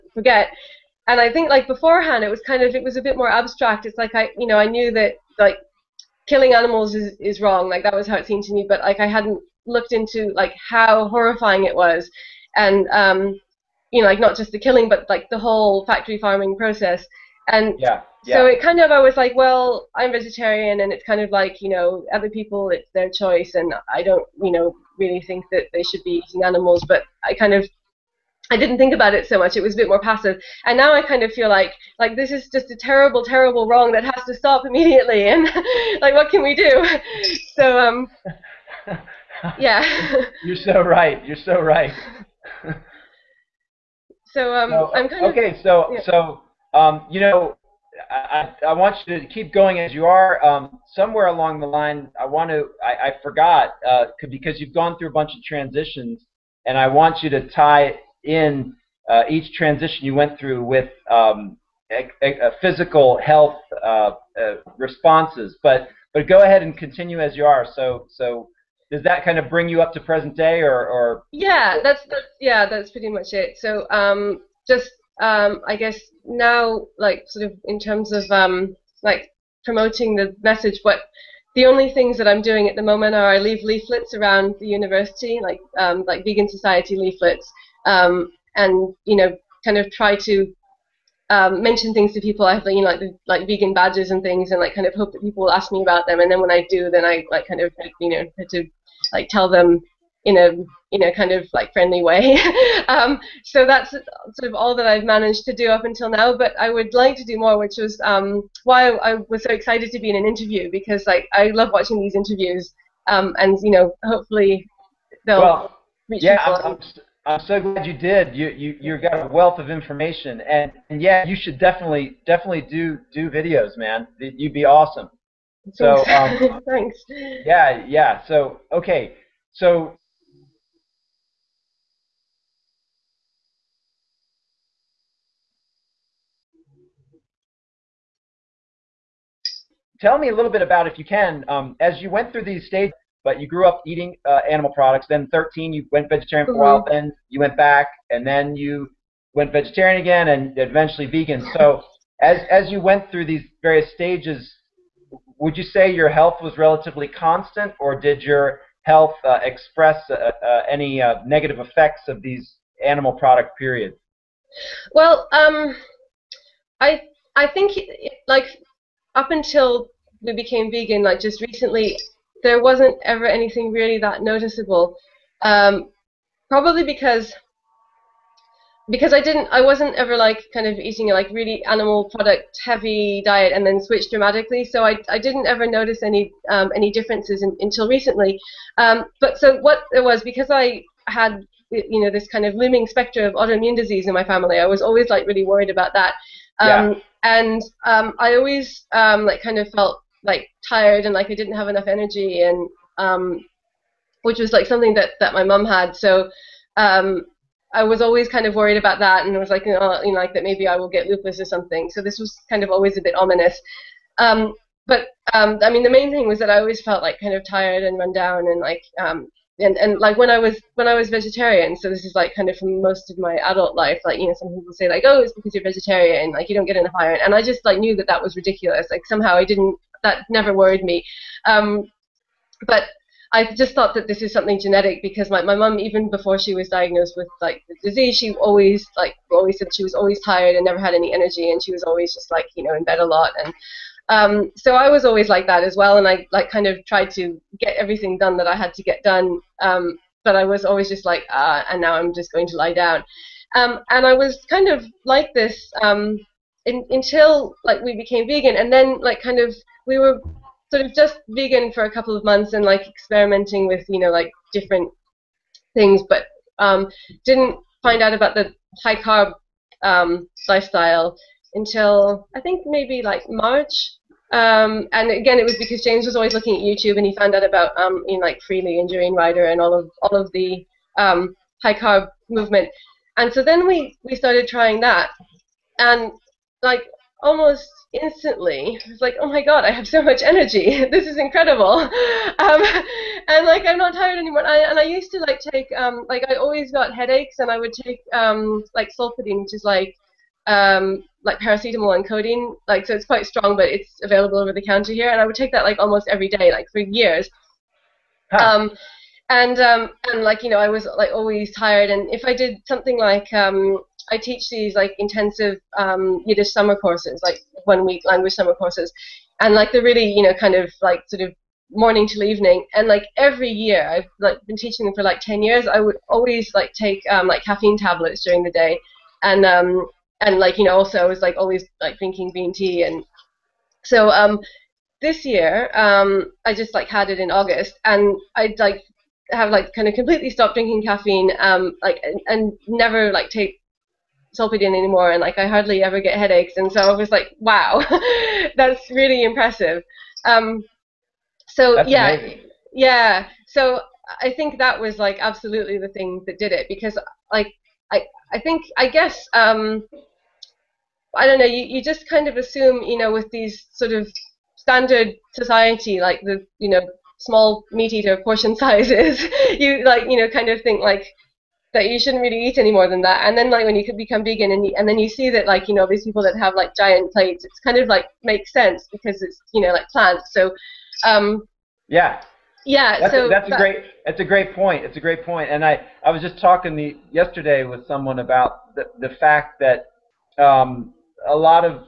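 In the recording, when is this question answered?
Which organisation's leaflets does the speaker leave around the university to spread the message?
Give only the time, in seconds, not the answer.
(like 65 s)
86 s.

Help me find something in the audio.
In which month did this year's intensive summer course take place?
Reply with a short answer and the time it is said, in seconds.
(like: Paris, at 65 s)
August, at 337 s.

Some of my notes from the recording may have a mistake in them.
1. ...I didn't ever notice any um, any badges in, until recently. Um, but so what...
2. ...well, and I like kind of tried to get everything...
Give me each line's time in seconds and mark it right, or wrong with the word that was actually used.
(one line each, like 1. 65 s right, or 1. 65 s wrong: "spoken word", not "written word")
1. 185 s wrong: "differences", not "badges"
2. 245 s right.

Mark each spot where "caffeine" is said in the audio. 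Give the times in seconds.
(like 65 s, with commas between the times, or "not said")
327 s, 340 s.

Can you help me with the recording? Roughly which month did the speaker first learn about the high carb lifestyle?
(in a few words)
March.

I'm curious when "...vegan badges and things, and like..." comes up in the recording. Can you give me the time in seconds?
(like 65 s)
93 s.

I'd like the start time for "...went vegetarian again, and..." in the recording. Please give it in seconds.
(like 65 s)
149 s.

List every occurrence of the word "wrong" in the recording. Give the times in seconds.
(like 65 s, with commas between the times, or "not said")
7 s, 33 s.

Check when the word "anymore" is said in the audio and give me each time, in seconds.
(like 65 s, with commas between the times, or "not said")
294 s, 344 s.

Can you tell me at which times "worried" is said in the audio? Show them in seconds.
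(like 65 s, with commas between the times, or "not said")
195 s, 208 s, 230 s.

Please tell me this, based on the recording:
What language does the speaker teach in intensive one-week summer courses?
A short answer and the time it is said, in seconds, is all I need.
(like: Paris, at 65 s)
Yiddish, at 316 s.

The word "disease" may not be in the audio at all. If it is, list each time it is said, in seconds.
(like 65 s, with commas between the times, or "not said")
193 s, 237 s.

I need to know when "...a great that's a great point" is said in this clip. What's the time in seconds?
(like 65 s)
383 s.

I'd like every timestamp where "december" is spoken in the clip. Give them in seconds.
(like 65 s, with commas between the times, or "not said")
not said.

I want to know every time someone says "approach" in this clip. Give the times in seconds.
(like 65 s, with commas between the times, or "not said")
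not said.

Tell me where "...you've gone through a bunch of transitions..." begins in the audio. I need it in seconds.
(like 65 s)
54 s.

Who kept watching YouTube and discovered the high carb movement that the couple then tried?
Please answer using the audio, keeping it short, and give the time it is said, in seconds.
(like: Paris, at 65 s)
James, at 275 s.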